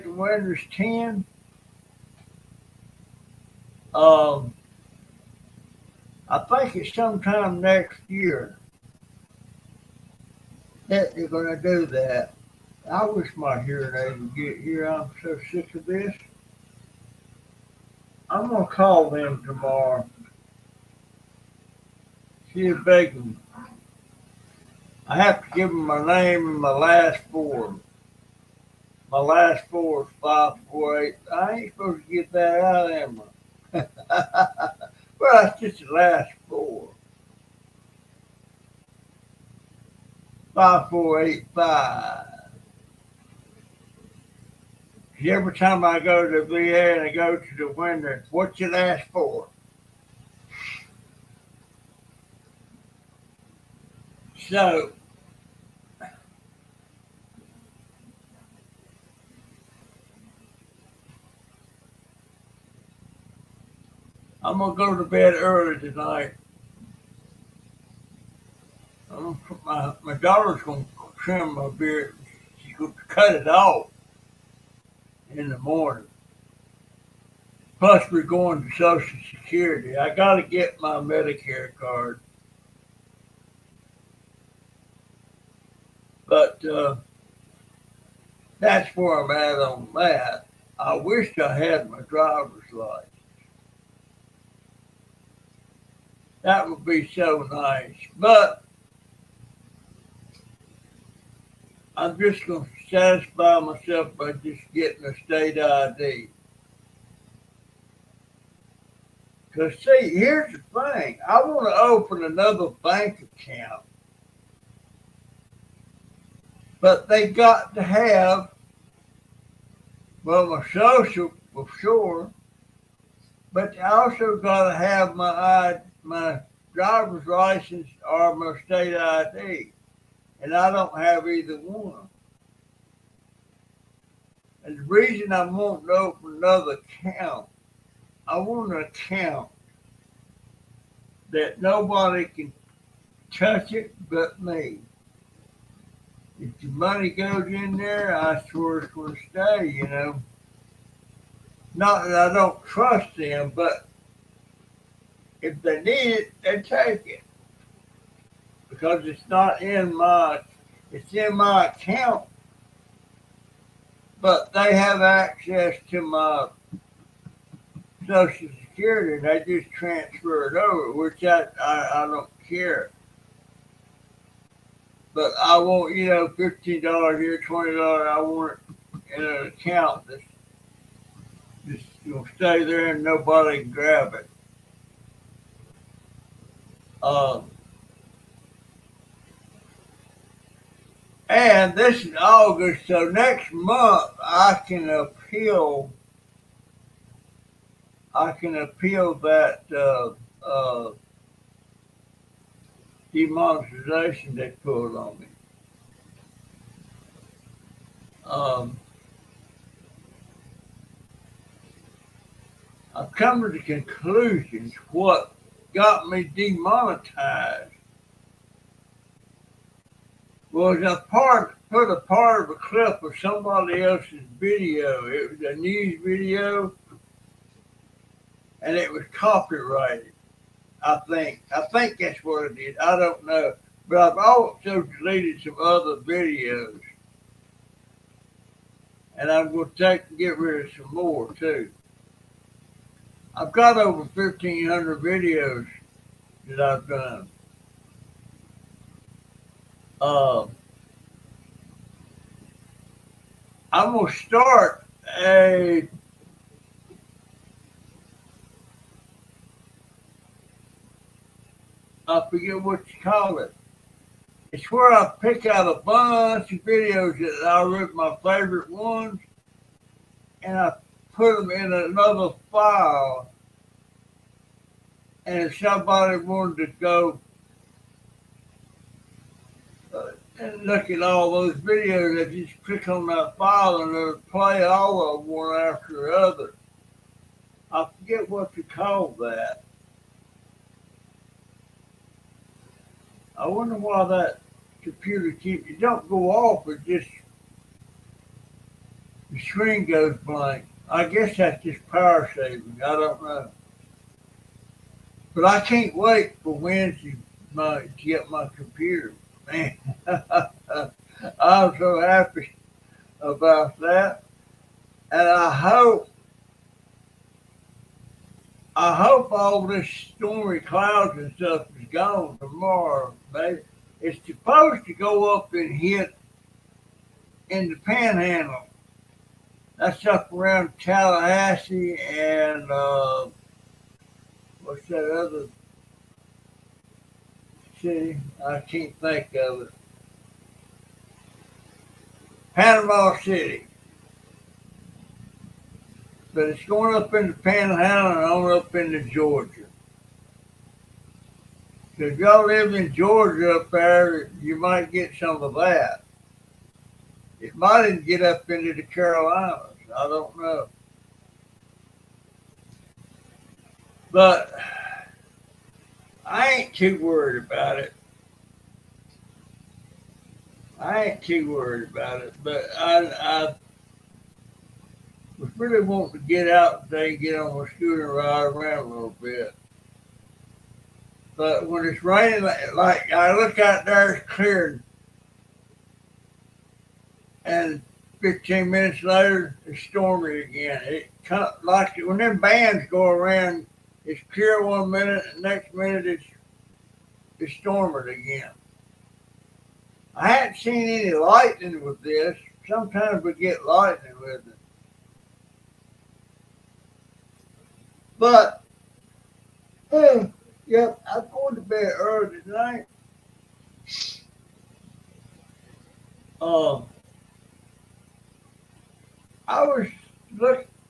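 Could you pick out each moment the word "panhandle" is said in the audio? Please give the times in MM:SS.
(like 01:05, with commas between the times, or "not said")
05:27, 05:47.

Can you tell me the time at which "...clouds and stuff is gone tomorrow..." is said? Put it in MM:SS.
05:20.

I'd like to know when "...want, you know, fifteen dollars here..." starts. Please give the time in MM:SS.
02:55.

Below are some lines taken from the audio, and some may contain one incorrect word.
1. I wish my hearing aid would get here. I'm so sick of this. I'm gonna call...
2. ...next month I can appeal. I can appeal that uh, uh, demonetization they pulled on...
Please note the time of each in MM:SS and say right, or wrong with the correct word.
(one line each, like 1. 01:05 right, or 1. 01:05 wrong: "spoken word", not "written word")
1. 00:12 right
2. 03:13 right.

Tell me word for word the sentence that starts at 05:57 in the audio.
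It might even get up into the Carolinas.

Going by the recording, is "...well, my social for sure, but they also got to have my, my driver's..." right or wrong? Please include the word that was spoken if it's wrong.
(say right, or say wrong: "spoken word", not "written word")
right.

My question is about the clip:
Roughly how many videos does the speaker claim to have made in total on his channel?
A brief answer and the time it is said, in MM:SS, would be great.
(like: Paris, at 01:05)
over 1500, at 04:03.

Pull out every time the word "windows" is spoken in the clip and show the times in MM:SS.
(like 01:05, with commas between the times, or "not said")
00:00, 00:47.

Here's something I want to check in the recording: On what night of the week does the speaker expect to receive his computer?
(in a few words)
Wednesday.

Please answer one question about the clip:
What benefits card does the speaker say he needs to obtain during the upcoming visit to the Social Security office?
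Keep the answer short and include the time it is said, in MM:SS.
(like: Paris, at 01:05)
Medicare card, at 01:20.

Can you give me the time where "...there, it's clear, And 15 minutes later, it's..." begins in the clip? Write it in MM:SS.
06:23.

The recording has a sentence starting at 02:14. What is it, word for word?
And the reason I want to open another account, I want an account that nobody can touch it but me.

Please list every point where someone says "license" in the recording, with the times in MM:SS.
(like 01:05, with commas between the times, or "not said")
01:32, 02:07.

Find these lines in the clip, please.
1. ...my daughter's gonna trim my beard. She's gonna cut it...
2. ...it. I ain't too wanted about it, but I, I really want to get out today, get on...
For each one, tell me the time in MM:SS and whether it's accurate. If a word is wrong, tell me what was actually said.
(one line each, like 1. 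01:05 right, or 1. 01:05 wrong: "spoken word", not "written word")
1. 01:10 right
2. 06:07 wrong: "worried", not "wanted".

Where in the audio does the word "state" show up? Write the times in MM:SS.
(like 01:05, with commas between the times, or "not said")
01:45, 02:08.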